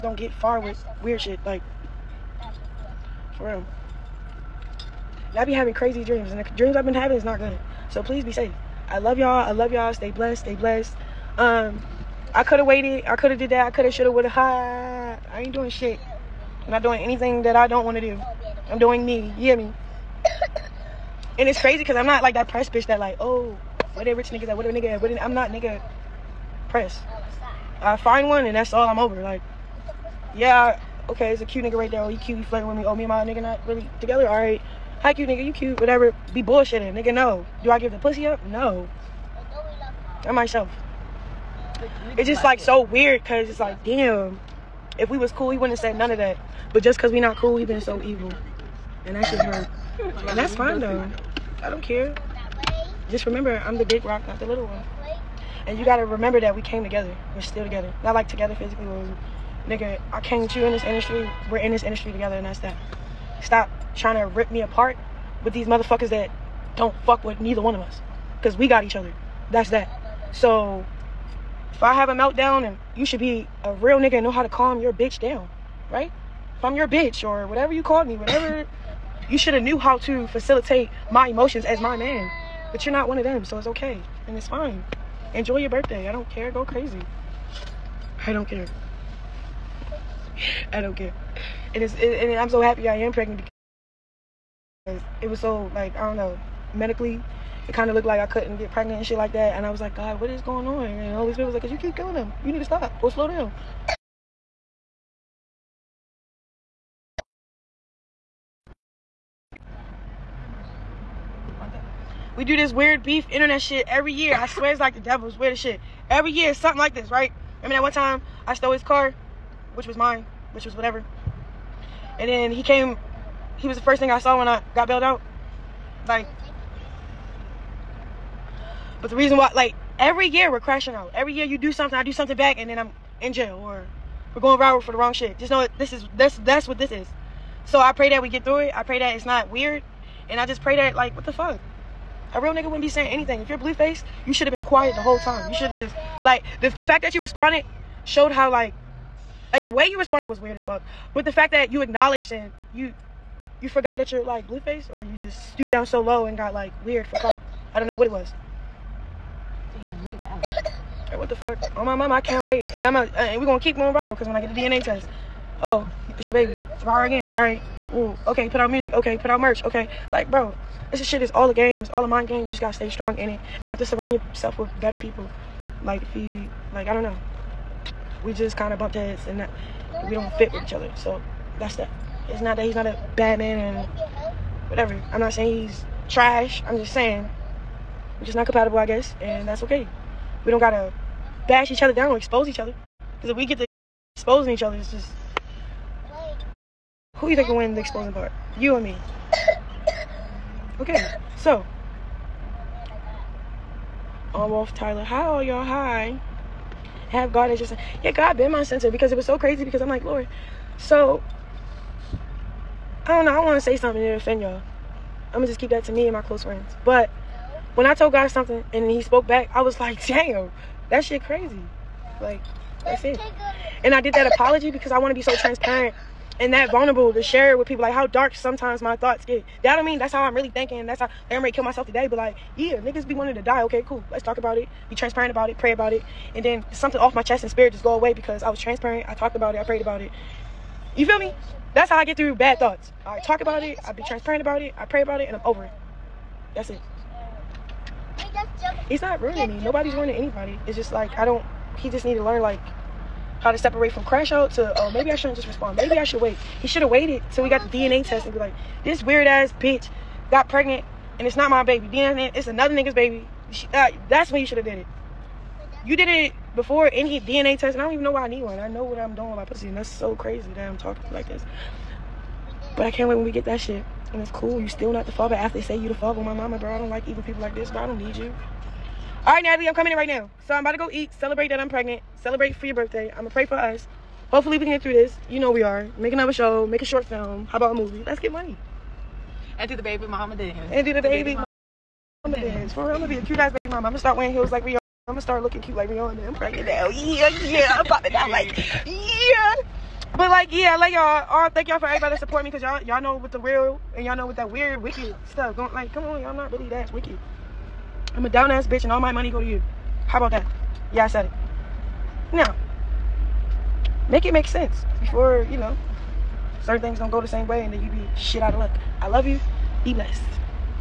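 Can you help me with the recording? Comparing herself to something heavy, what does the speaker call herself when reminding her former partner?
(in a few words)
the big rock.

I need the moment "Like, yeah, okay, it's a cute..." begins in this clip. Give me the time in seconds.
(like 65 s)
29 s.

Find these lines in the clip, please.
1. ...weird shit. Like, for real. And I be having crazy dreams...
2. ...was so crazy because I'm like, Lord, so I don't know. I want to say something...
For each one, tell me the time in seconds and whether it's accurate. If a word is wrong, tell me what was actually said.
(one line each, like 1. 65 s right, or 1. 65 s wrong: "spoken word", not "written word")
1. 1 s right
2. 209 s right.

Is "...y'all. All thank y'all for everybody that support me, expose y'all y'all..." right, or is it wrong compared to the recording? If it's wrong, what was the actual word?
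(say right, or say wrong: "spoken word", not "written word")
wrong: "cause", not "expose".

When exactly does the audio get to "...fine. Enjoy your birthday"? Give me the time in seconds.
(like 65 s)
84 s.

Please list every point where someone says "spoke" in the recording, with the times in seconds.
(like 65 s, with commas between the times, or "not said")
219 s.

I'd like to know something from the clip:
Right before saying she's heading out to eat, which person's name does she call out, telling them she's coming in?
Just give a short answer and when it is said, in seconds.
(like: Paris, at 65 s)
Natalie, at 279 s.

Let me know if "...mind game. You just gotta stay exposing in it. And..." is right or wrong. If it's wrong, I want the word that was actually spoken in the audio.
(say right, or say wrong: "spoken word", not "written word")
wrong: "strong", not "exposing".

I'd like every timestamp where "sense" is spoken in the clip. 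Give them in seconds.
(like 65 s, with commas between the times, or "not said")
314 s.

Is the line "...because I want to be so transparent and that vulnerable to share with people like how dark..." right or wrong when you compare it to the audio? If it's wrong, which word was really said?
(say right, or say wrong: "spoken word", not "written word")
right.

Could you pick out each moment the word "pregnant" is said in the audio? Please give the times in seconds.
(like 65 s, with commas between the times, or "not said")
93 s, 98 s, 260 s, 281 s, 296 s.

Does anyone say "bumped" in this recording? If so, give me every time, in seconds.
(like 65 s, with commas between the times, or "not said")
178 s.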